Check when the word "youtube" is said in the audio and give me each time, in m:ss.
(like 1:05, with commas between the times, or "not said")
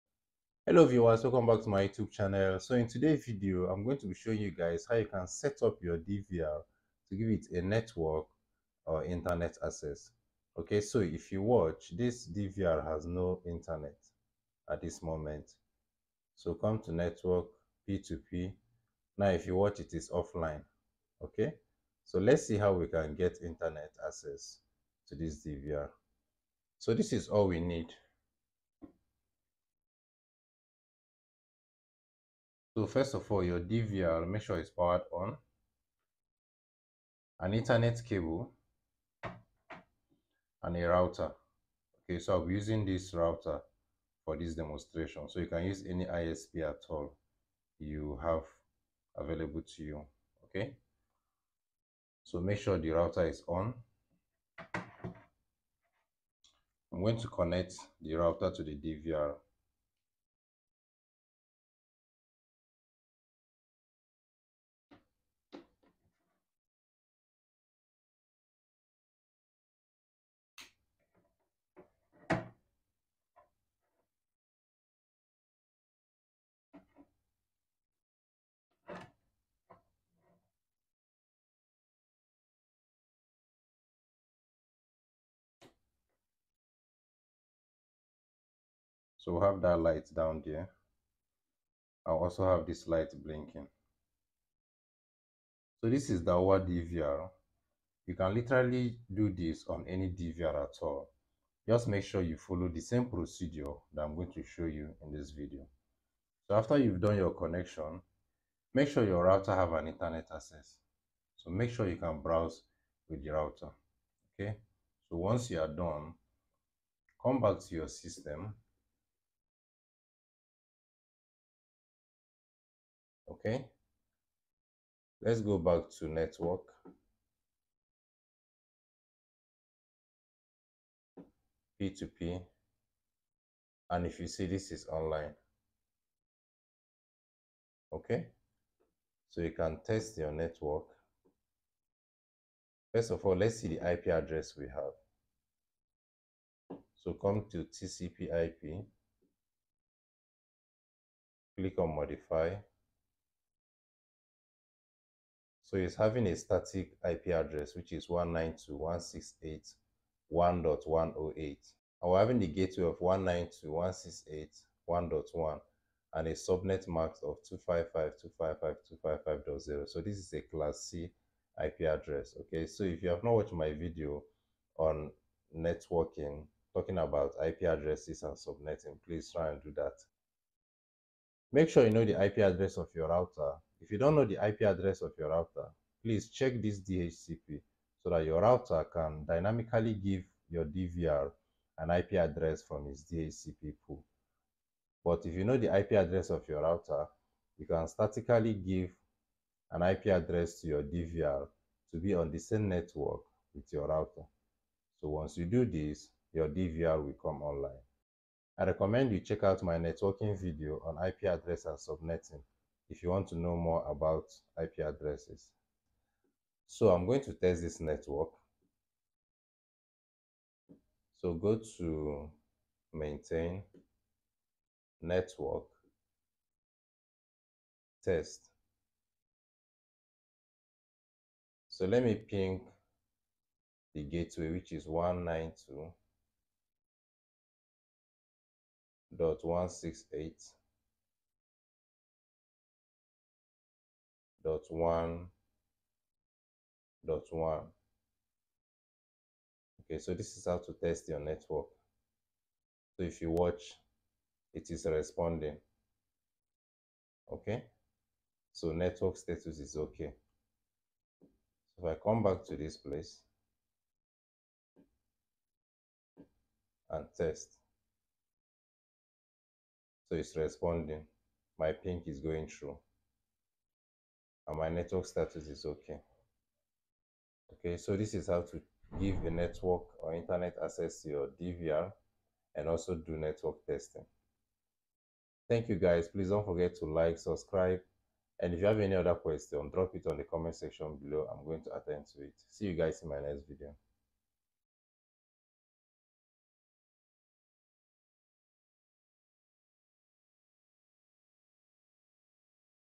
0:01.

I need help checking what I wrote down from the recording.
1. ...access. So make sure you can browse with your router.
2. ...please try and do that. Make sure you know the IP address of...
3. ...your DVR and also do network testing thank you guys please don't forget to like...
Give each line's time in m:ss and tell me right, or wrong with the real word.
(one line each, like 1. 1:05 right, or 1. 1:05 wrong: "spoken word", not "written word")
1. 1:50 right
2. 2:59 right
3. 4:41 right.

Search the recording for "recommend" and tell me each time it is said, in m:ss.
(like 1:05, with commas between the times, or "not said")
3:28.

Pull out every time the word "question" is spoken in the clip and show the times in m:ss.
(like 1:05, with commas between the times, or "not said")
4:49.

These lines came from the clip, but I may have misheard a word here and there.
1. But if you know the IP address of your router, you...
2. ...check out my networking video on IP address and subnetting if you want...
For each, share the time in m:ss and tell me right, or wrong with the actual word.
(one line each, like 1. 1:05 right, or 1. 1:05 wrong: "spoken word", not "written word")
1. 3:15 right
2. 3:29 right.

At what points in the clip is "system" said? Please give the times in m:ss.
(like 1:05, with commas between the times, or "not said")
1:57.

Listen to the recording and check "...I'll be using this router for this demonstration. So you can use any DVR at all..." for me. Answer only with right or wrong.
wrong.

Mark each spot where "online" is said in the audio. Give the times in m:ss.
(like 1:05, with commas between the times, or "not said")
2:14, 3:27.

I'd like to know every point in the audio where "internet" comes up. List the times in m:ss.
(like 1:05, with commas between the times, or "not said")
0:09, 0:13, 0:23, 1:49, 4:40.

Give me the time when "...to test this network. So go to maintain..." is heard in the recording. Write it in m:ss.
3:37.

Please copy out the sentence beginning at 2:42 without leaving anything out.
And we're having the gateway of 192.168.1.1 and a subnet mask of 255.255.255.0.